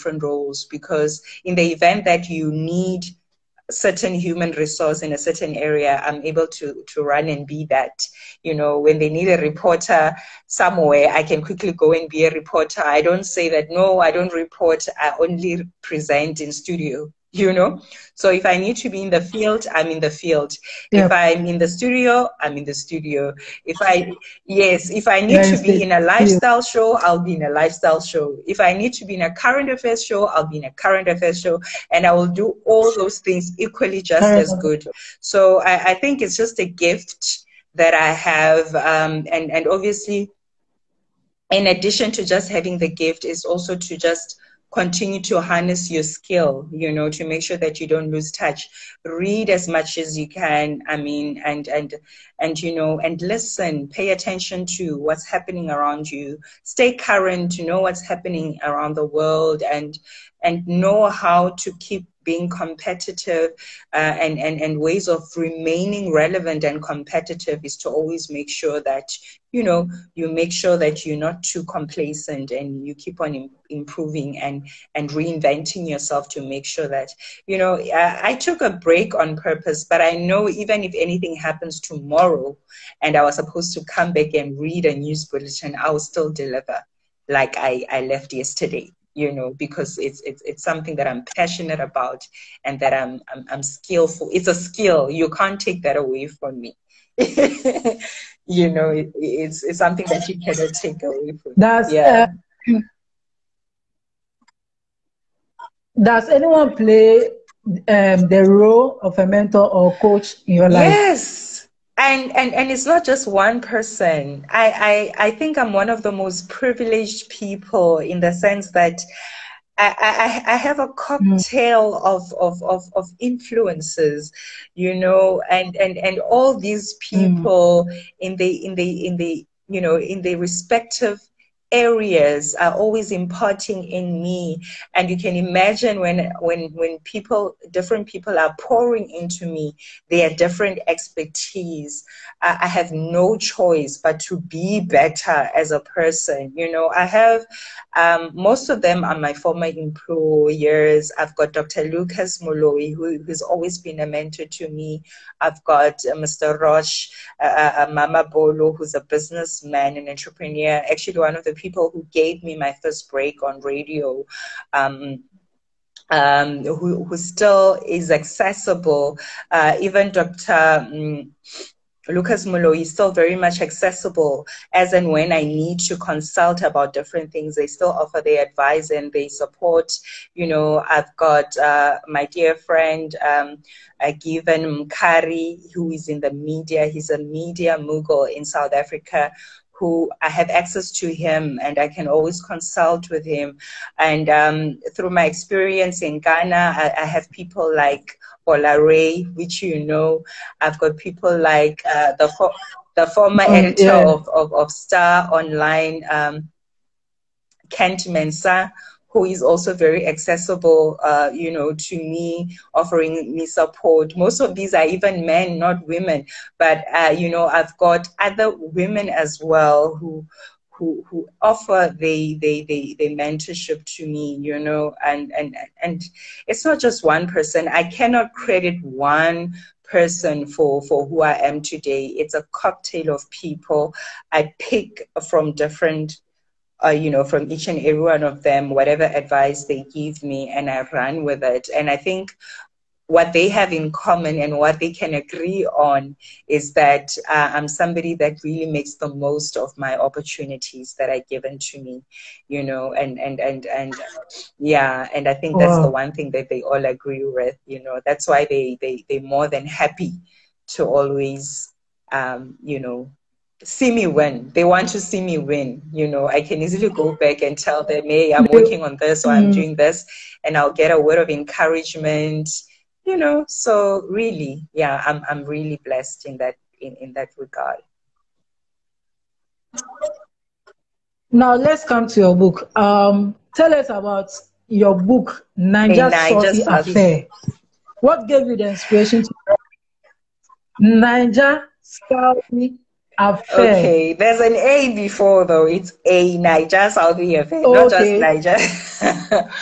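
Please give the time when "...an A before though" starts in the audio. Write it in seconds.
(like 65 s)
294 s.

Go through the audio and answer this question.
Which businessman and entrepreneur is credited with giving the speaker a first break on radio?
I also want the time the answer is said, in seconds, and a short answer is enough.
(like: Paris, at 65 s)
Mama Bolo, at 157 s.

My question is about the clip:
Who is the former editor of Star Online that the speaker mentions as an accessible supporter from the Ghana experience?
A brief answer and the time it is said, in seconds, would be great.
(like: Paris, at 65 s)
Kent Mensah, at 207 s.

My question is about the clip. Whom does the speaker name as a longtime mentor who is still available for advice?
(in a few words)
Dr Lucas Moloi.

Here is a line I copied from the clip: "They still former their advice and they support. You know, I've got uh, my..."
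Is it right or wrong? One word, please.
wrong.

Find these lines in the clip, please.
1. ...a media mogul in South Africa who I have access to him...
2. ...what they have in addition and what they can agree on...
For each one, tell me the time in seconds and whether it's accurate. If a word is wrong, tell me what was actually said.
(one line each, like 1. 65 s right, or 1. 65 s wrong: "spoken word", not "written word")
1. 187 s right
2. 243 s wrong: "common", not "addition".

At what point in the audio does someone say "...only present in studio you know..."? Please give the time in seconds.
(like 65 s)
15 s.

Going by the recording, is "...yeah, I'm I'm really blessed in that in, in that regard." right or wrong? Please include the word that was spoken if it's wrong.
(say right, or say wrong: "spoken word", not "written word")
right.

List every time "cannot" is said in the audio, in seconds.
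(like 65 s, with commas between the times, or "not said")
100 s, 227 s.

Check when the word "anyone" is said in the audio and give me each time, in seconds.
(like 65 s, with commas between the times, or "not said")
106 s.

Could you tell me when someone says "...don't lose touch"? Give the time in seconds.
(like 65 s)
47 s.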